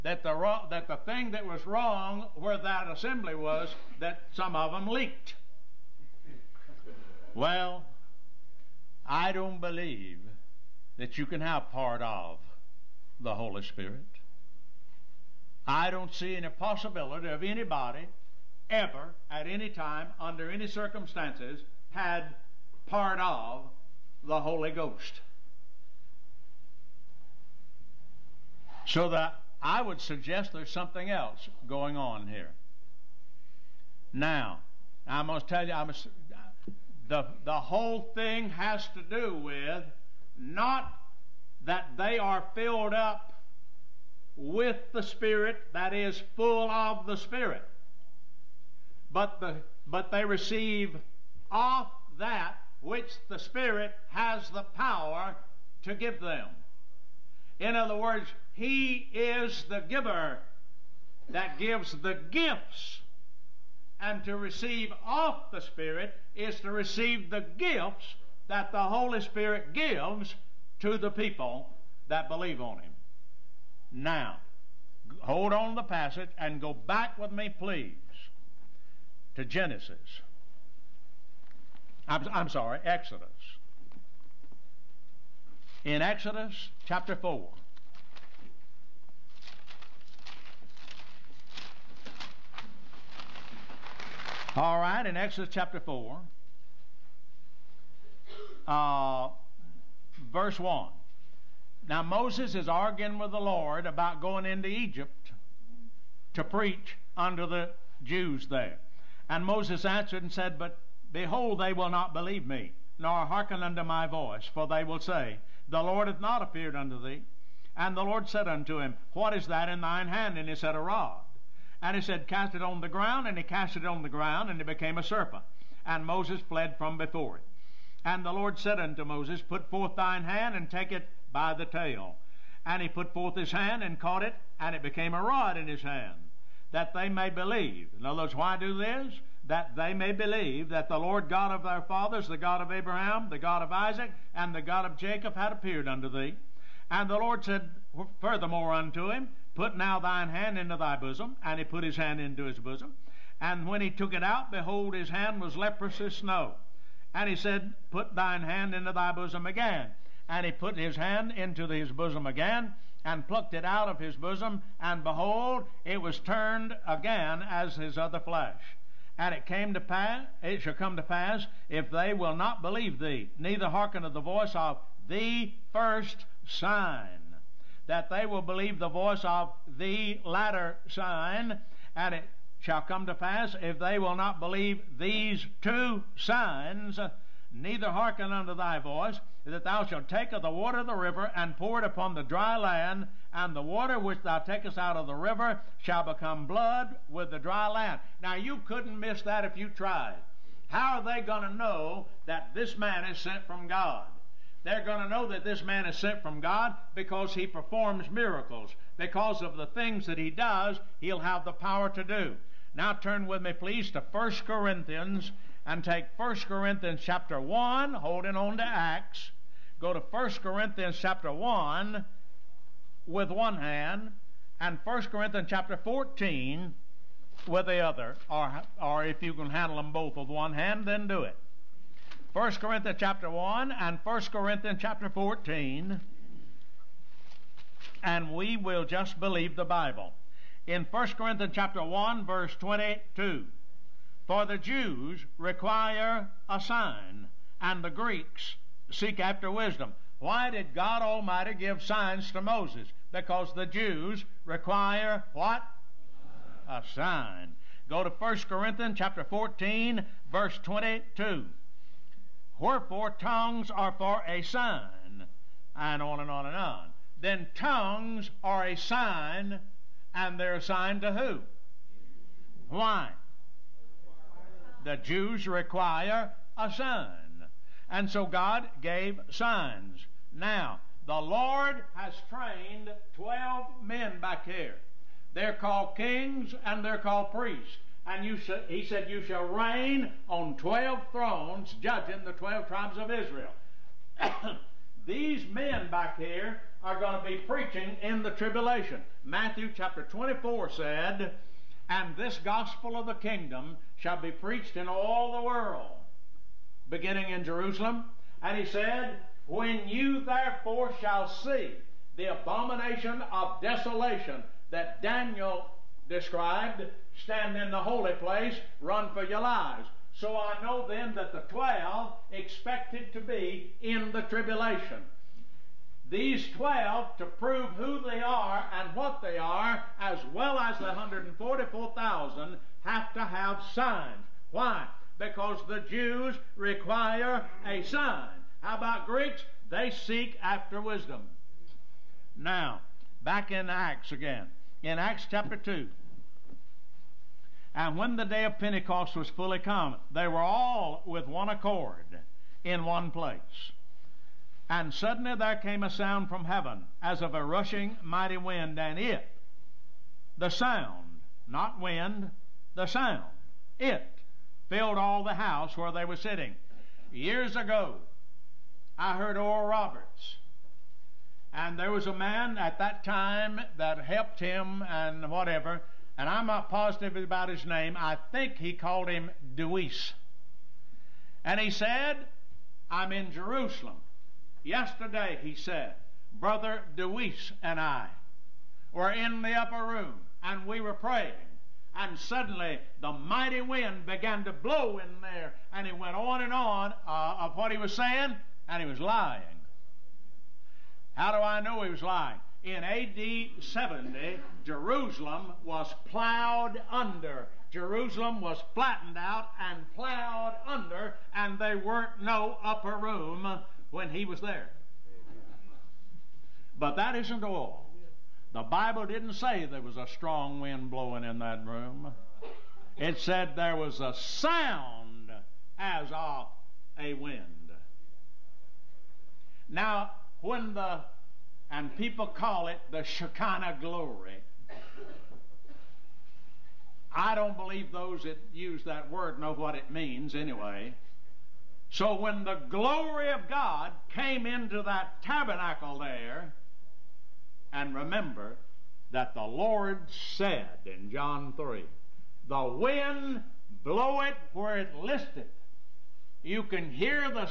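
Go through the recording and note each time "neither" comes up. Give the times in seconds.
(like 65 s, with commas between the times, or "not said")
173 s, 187 s.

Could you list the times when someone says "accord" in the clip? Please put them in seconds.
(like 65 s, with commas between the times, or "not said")
351 s.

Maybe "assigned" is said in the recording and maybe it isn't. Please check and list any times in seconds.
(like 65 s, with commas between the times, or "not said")
270 s.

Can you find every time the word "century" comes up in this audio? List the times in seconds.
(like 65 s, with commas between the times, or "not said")
not said.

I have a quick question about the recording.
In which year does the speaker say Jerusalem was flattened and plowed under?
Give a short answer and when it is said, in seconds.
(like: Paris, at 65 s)
AD 70, at 402 s.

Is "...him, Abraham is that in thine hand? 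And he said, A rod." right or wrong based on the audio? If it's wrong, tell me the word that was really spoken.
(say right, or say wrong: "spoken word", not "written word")
wrong: "What", not "Abraham".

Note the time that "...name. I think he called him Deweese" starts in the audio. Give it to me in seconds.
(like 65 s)
377 s.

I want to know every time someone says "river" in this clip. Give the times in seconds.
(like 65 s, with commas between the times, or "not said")
190 s, 195 s.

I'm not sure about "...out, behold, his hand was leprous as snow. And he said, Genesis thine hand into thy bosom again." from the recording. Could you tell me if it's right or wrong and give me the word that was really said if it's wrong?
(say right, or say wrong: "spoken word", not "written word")
wrong: "Put", not "Genesis".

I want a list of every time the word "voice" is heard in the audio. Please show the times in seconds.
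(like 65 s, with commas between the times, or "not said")
114 s, 174 s, 178 s, 188 s.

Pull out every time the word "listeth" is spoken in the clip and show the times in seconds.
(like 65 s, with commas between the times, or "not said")
454 s.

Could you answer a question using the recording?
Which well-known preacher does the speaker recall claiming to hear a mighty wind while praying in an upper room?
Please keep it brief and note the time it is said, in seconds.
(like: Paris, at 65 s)
Oral Roberts, at 369 s.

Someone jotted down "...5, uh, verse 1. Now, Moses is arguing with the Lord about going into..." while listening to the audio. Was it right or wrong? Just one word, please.
wrong.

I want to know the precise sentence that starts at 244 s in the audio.
For the Jews require a sign, and the Greeks seek after wisdom.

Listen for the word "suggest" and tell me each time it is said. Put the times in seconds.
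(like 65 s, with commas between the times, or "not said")
29 s.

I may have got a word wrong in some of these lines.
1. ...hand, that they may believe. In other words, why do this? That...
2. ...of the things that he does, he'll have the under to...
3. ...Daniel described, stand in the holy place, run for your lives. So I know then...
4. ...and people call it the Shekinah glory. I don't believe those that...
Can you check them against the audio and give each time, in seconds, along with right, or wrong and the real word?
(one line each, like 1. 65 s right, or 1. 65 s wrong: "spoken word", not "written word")
1. 135 s right
2. 209 s wrong: "power", not "under"
3. 315 s right
4. 431 s right.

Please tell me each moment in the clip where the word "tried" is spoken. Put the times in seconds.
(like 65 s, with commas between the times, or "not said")
199 s.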